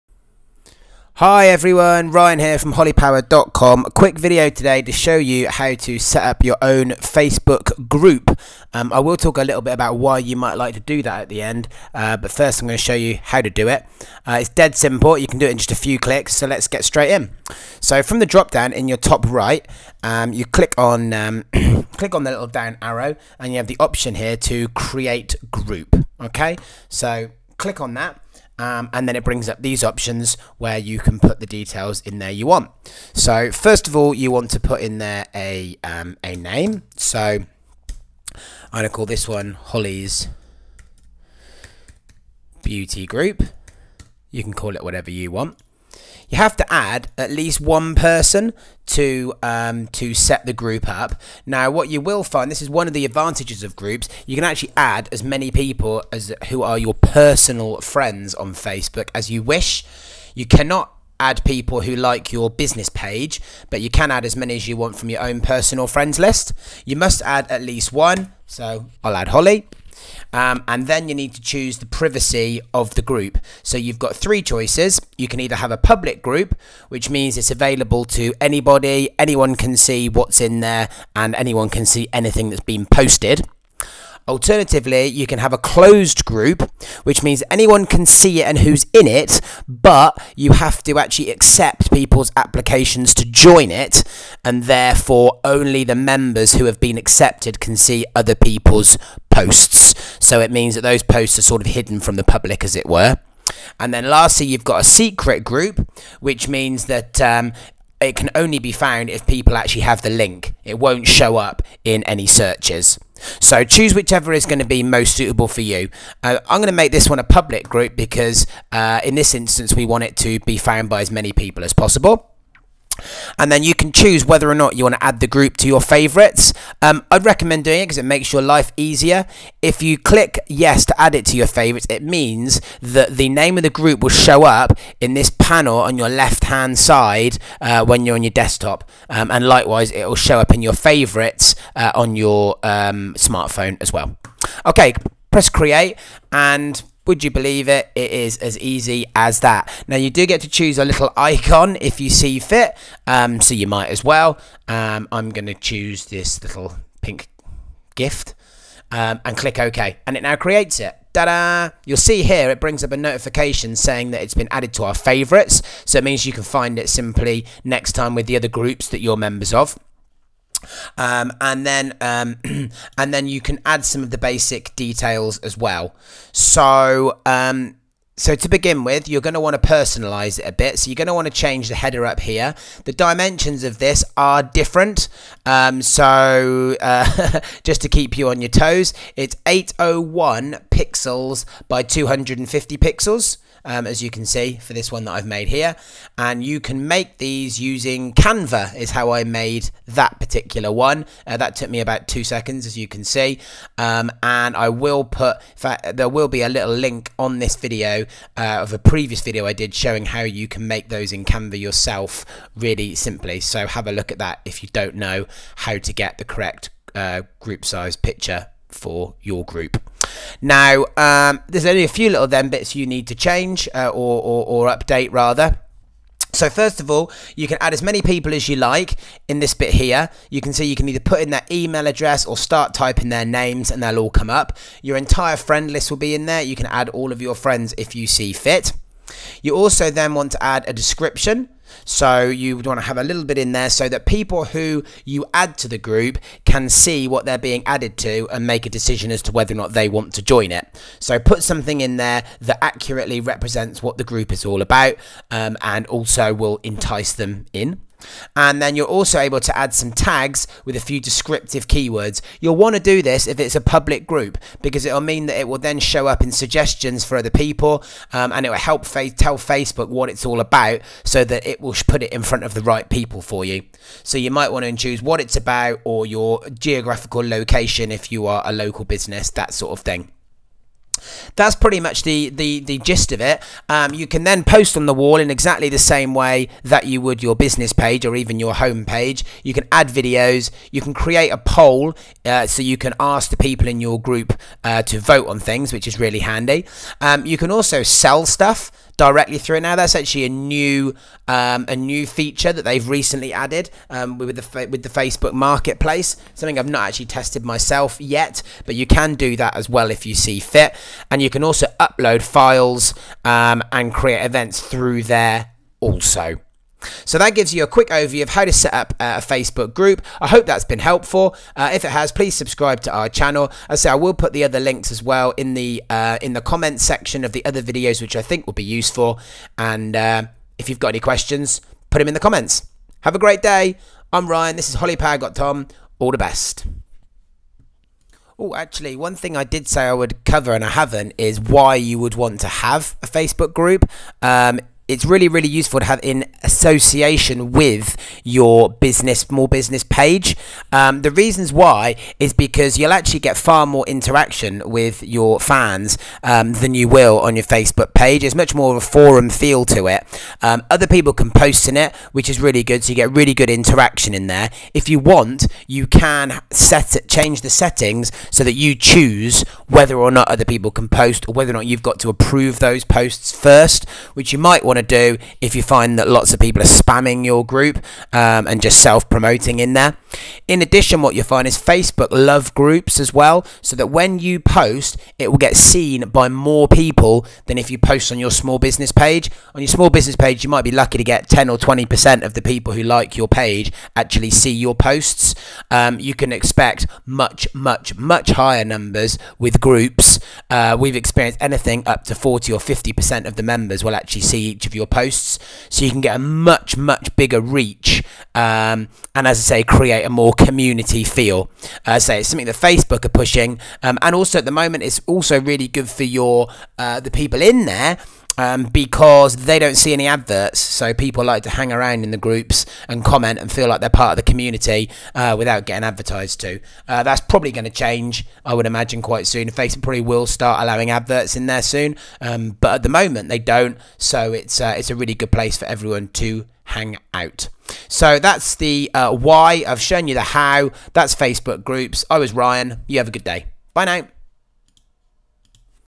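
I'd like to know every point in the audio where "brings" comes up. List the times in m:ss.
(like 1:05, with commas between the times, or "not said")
0:29, 2:42.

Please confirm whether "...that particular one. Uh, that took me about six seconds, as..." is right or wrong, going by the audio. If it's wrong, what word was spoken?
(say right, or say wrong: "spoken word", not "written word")
wrong: "two", not "six".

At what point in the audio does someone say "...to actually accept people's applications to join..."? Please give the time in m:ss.
1:30.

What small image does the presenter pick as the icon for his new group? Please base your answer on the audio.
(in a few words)
Pink gift.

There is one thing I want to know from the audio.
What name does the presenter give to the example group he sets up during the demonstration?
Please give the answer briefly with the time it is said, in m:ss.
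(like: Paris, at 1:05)
Holly's Beauty Group, at 0:39.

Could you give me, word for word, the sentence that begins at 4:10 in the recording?
So put something in there that accurately represents what the group is all about um, and also will entice them in.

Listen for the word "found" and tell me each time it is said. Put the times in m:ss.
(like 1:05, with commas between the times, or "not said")
1:48, 2:00.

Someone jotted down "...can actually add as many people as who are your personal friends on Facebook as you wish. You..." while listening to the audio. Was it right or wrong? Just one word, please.
right.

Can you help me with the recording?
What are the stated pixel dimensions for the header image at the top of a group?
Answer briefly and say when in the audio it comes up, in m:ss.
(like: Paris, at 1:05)
801 by 250 pixels, at 3:09.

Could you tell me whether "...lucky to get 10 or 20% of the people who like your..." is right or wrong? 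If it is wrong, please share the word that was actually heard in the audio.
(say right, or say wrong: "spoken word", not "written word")
right.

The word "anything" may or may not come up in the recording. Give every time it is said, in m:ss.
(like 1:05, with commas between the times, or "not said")
1:22, 6:41.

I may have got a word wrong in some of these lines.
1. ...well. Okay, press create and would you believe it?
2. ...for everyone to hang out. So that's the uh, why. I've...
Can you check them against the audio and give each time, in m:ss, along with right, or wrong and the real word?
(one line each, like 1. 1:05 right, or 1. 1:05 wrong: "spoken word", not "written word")
1. 2:23 right
2. 7:15 right.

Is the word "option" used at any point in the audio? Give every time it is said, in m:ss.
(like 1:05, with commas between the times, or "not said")
0:23, 0:29.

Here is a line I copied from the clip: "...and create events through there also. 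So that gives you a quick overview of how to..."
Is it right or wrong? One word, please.
right.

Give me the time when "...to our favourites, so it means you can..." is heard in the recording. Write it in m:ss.
2:44.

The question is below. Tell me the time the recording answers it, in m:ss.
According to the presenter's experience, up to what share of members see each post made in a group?
6:42.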